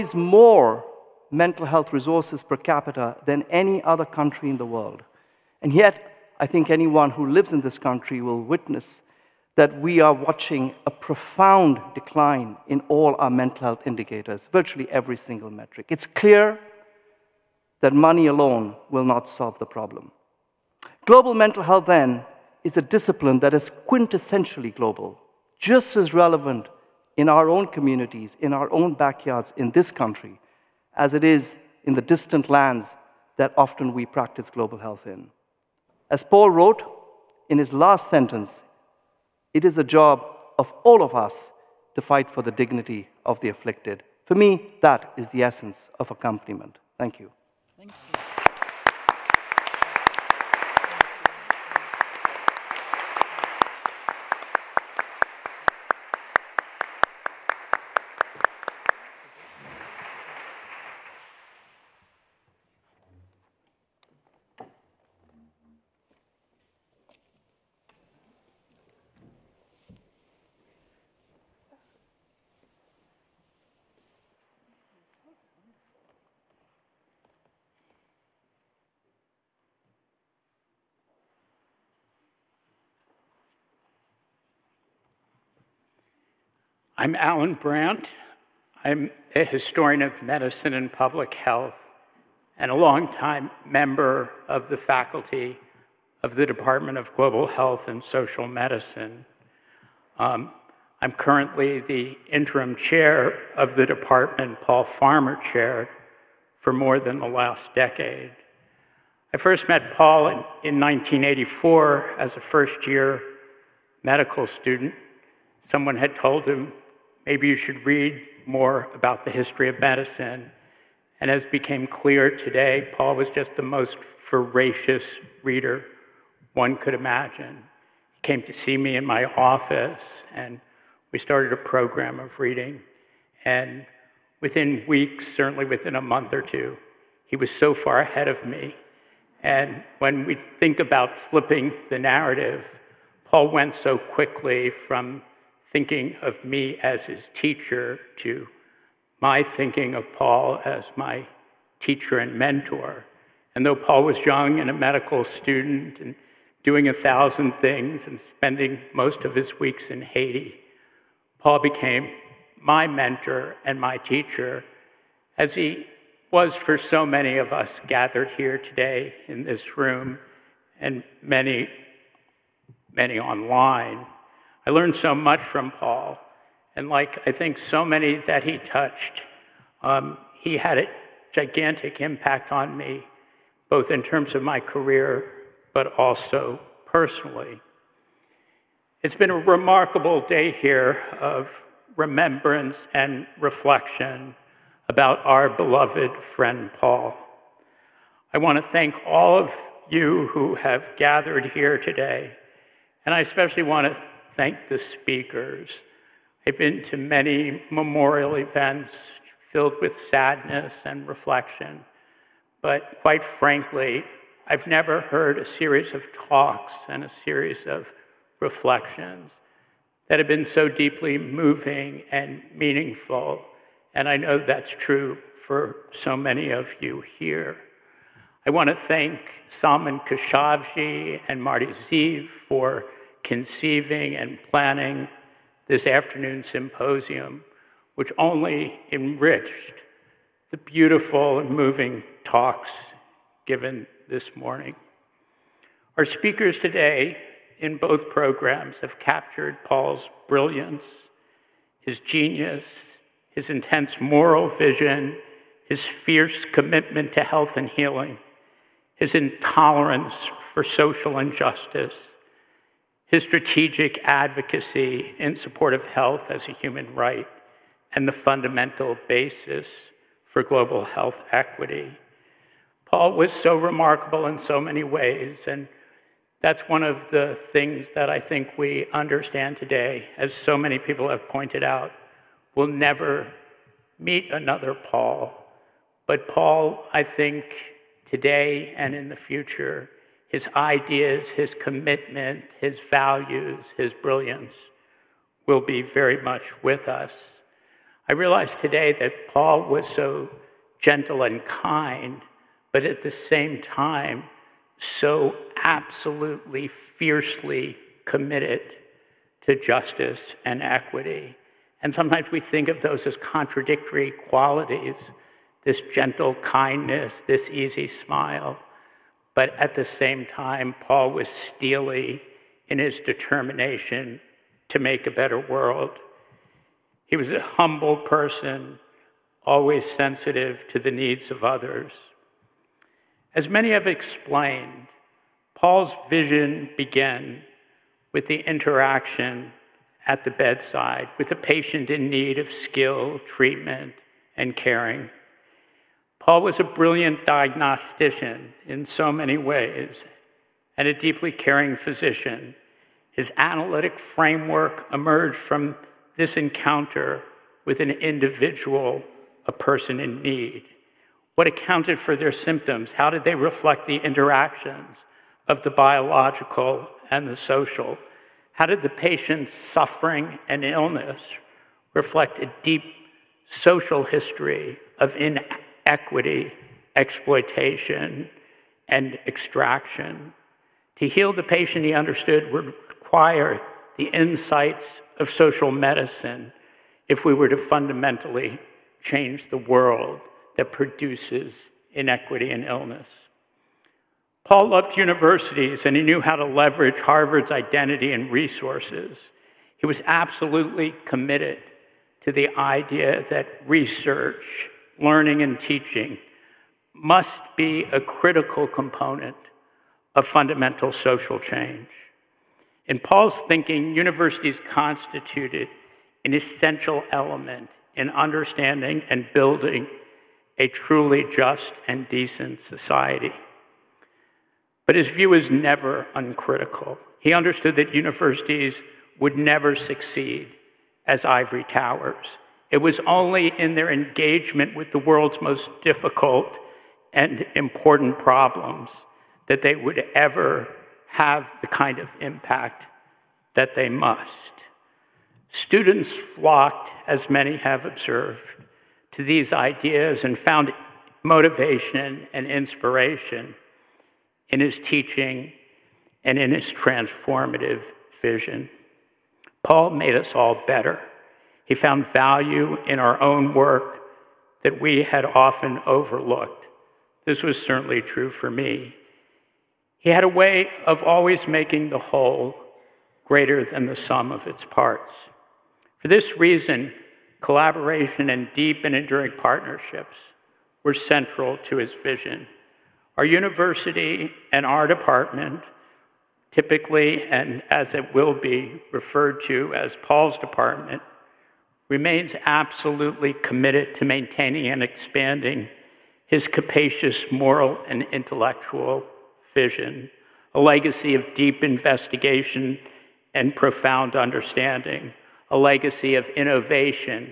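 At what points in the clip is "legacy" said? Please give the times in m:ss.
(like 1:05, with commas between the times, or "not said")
8:20, 8:25.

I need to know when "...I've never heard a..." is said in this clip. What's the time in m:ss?
3:34.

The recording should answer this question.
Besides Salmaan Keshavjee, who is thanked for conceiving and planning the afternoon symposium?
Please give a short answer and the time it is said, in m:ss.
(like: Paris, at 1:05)
Marty Zeve, at 3:51.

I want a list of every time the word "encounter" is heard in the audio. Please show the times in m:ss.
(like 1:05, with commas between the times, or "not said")
5:56.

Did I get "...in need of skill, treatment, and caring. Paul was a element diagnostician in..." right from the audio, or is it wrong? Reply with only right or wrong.
wrong.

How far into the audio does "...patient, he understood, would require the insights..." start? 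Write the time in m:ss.
6:21.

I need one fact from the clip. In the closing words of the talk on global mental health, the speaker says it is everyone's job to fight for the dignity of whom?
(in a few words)
the afflicted.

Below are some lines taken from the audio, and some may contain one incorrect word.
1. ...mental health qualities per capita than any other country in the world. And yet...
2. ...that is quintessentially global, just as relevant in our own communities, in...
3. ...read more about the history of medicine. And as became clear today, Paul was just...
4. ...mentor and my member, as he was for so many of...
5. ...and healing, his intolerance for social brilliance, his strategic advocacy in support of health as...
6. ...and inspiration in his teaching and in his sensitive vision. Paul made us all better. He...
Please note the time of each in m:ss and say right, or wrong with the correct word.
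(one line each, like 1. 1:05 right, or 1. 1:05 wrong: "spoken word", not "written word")
1. 0:01 wrong: "resources", not "qualities"
2. 0:23 right
3. 1:57 right
4. 2:42 wrong: "teacher", not "member"
5. 4:17 wrong: "injustice", not "brilliance"
6. 7:32 wrong: "transformative", not "sensitive".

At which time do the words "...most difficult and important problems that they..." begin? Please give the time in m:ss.
7:15.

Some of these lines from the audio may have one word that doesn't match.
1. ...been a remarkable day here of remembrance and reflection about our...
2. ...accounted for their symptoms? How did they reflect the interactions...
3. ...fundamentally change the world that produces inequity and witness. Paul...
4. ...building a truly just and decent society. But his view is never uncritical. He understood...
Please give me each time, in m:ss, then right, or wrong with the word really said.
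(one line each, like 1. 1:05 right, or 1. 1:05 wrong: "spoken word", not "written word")
1. 3:09 right
2. 6:01 right
3. 6:27 wrong: "illness", not "witness"
4. 6:59 right.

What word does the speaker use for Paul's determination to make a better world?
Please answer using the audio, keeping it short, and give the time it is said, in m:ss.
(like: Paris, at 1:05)
steely, at 5:21.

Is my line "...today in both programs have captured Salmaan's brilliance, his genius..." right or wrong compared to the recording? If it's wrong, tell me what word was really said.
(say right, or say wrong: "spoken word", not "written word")
wrong: "Paul", not "Salmaan".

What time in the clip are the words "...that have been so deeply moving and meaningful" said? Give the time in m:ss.
3:40.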